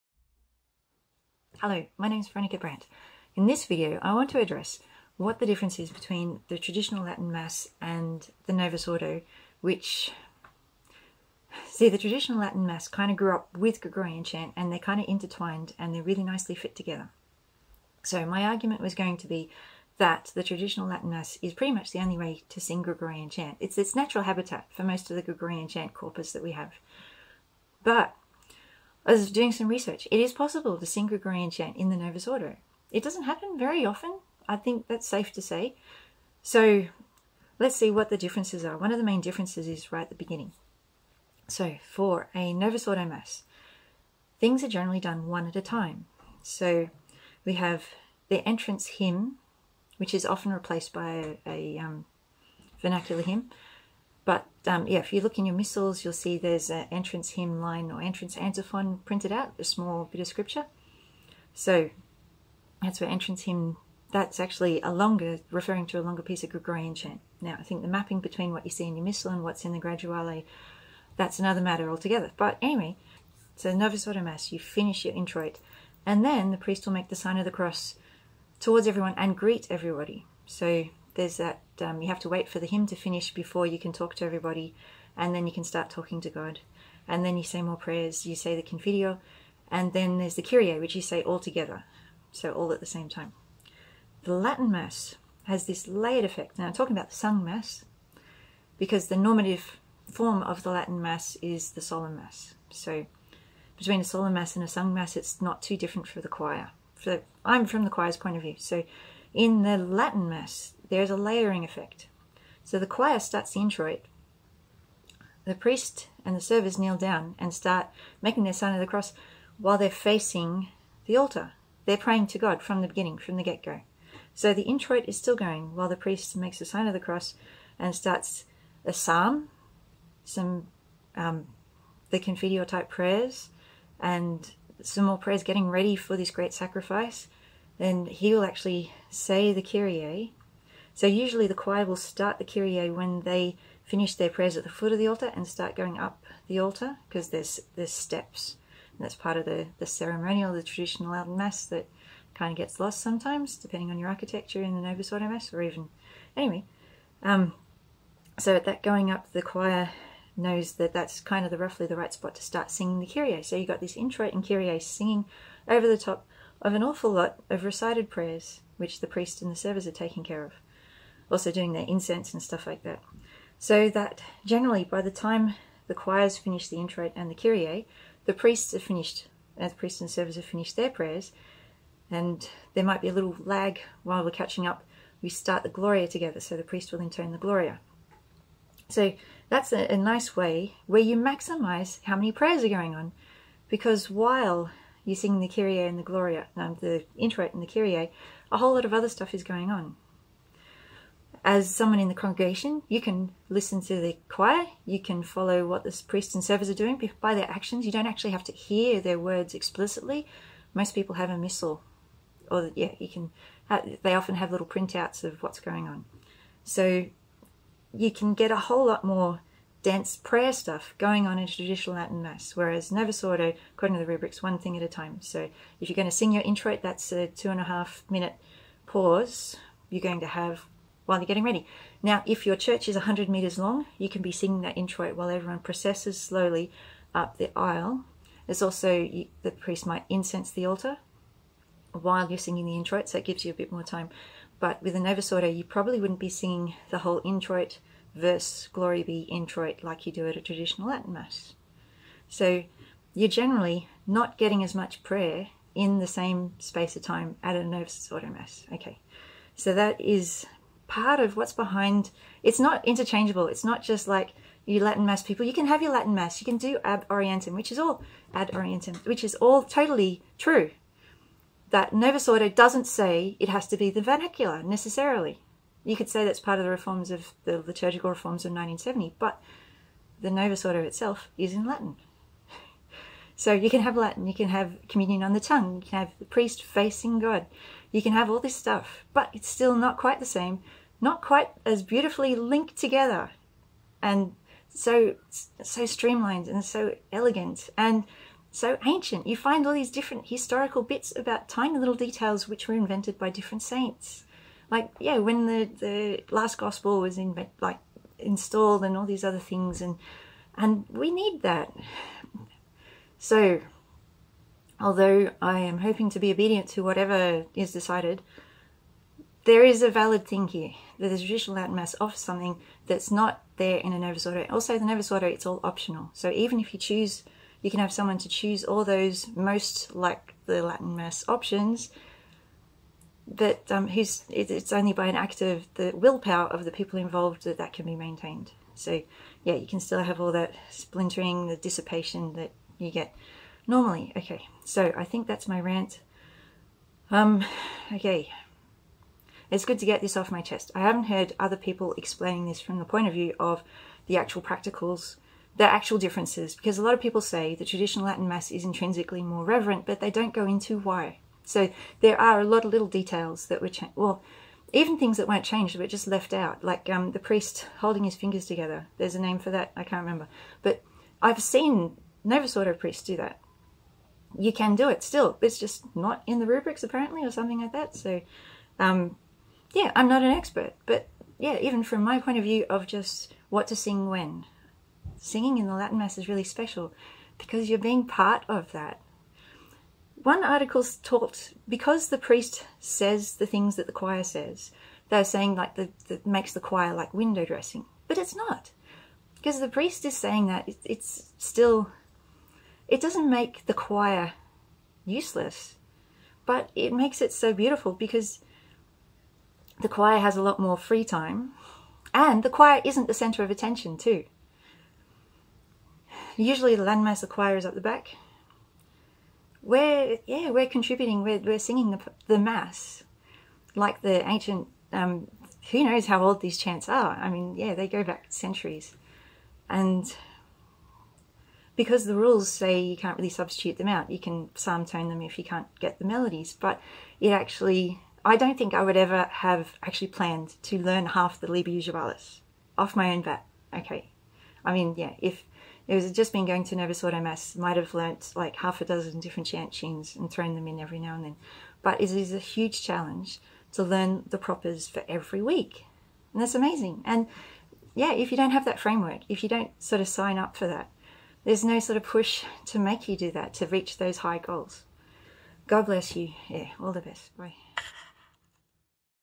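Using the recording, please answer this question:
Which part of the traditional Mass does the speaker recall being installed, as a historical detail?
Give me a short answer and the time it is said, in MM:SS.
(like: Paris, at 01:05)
The last gospel, at 05:06.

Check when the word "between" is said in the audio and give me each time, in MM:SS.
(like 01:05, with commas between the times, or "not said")
00:05, 01:08, 01:43.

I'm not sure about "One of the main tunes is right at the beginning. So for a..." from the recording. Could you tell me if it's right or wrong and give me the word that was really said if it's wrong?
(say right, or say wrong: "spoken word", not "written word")
wrong: "differences", not "tunes".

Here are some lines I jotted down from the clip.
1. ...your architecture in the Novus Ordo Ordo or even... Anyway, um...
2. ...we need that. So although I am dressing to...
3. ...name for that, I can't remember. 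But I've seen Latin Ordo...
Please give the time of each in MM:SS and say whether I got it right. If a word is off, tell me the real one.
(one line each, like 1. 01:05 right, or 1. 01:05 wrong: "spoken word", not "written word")
1. 02:33 wrong: "Mass", not "Ordo"
2. 05:10 wrong: "hoping", not "dressing"
3. 06:09 wrong: "Novus", not "Latin".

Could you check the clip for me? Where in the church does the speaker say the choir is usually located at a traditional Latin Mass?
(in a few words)
Up the back.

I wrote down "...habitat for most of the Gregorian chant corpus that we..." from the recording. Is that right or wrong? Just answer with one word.
right.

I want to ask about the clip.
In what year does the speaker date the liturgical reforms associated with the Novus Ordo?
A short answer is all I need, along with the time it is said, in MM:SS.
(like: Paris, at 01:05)
1970, at 04:38.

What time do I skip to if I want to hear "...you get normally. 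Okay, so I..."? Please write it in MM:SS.
05:42.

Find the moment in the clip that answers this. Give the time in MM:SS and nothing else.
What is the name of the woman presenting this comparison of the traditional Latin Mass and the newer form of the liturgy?
00:02.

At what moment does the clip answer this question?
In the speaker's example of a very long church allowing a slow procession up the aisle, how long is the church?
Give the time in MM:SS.
03:52.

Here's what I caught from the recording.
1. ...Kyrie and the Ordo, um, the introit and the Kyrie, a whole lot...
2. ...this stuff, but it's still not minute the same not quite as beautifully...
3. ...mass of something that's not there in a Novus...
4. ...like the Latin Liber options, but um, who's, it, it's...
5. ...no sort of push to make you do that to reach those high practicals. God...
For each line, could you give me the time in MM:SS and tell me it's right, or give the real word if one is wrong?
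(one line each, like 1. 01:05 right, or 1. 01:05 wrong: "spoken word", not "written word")
1. 03:15 wrong: "Gloria", not "Ordo"
2. 04:48 wrong: "quite", not "minute"
3. 05:21 right
4. 05:29 wrong: "Mass", not "Liber"
5. 07:41 wrong: "goals", not "practicals".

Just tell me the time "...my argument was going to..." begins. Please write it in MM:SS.
00:18.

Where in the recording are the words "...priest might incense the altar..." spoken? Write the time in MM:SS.
03:59.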